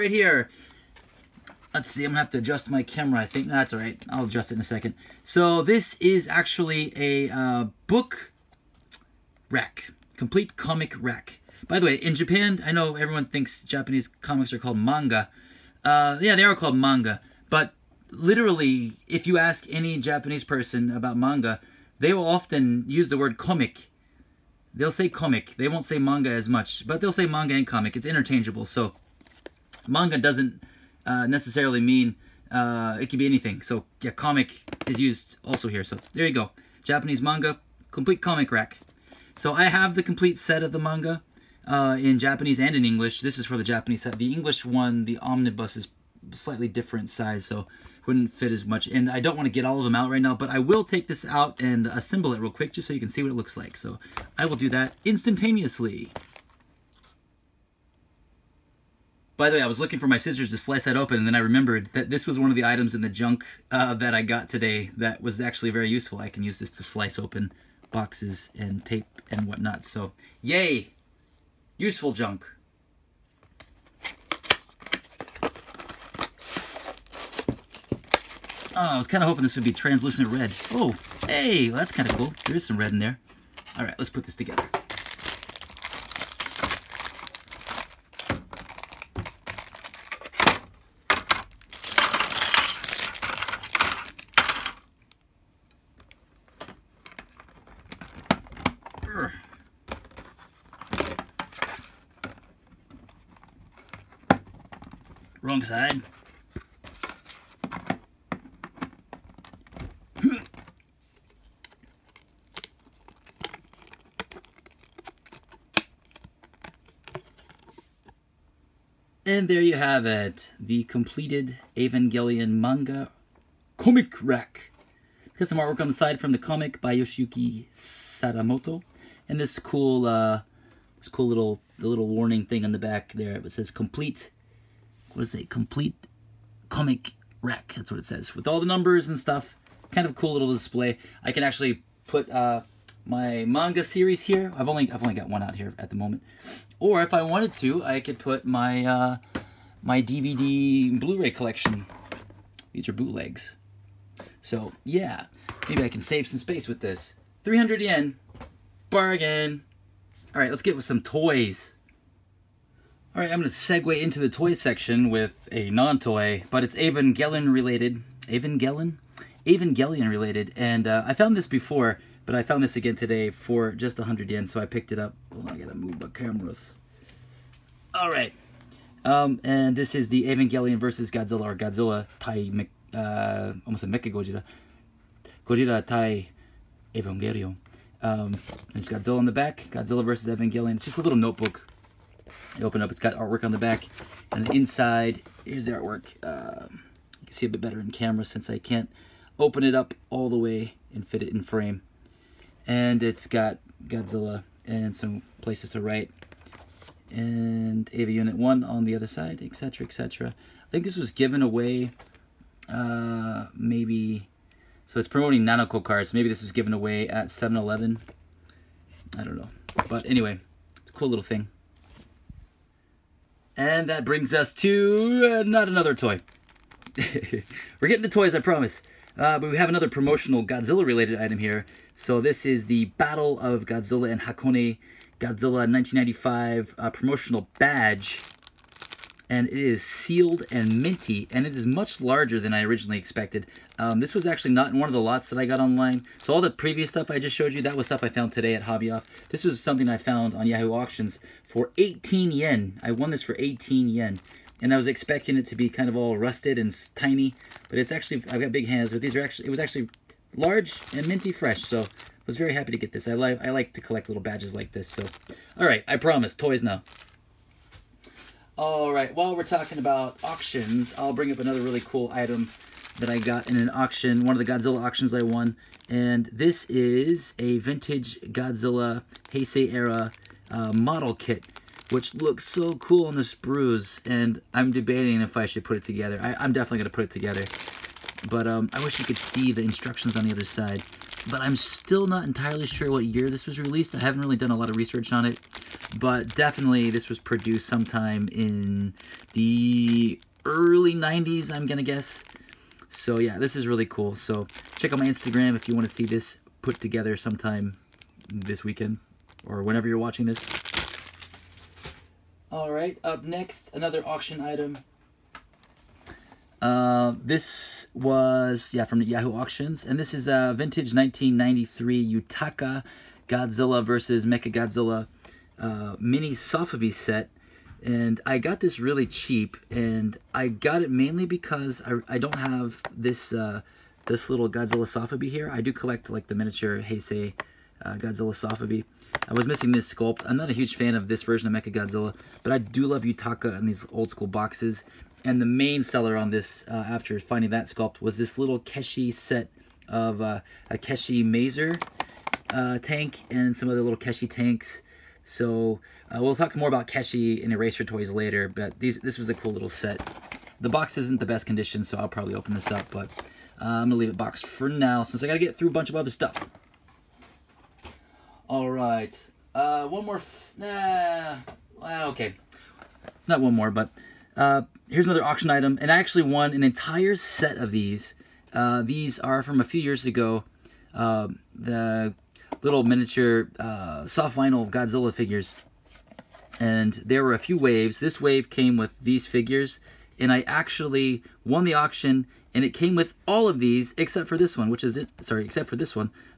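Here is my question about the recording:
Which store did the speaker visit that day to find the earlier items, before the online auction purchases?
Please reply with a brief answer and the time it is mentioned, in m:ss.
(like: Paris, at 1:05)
Hobby Off, at 4:08.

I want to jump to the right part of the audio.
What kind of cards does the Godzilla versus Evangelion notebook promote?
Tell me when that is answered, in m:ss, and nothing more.
3:35.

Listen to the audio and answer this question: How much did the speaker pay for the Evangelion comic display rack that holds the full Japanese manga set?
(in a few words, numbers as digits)
300 yen.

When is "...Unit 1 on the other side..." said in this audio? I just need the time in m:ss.
3:28.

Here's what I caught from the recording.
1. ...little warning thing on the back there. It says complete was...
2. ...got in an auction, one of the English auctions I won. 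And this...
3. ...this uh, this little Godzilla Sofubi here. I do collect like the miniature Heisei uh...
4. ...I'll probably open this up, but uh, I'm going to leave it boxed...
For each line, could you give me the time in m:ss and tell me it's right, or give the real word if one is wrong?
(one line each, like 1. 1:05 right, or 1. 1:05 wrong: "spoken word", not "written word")
1. 2:11 right
2. 4:33 wrong: "Godzilla", not "English"
3. 5:32 right
4. 6:01 right.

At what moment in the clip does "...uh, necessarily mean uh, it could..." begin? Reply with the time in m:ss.
0:31.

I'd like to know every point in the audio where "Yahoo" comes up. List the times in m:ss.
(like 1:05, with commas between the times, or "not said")
4:10, 5:19.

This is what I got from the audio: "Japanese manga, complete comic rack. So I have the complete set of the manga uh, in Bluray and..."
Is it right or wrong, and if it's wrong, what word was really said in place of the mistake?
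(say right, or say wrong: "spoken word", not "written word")
wrong: "Japanese", not "Bluray".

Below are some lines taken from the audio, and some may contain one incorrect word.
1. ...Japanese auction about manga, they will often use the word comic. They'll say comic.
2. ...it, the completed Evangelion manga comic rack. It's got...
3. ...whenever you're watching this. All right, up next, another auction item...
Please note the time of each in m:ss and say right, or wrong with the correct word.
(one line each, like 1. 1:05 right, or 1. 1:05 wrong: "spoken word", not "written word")
1. 0:19 wrong: "person", not "auction"
2. 2:00 right
3. 5:09 right.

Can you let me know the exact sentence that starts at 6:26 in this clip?
And there were a few waves.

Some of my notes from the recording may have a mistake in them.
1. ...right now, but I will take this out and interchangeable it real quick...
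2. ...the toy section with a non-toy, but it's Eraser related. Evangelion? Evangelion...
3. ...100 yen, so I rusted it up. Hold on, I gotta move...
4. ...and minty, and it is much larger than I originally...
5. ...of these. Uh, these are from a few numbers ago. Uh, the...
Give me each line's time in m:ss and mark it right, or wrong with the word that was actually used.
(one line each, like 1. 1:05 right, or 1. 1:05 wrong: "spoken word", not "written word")
1. 0:50 wrong: "assemble", not "interchangeable"
2. 2:44 wrong: "Evangelion", not "Eraser"
3. 2:53 wrong: "picked", not "rusted"
4. 4:00 right
5. 6:17 wrong: "years", not "numbers".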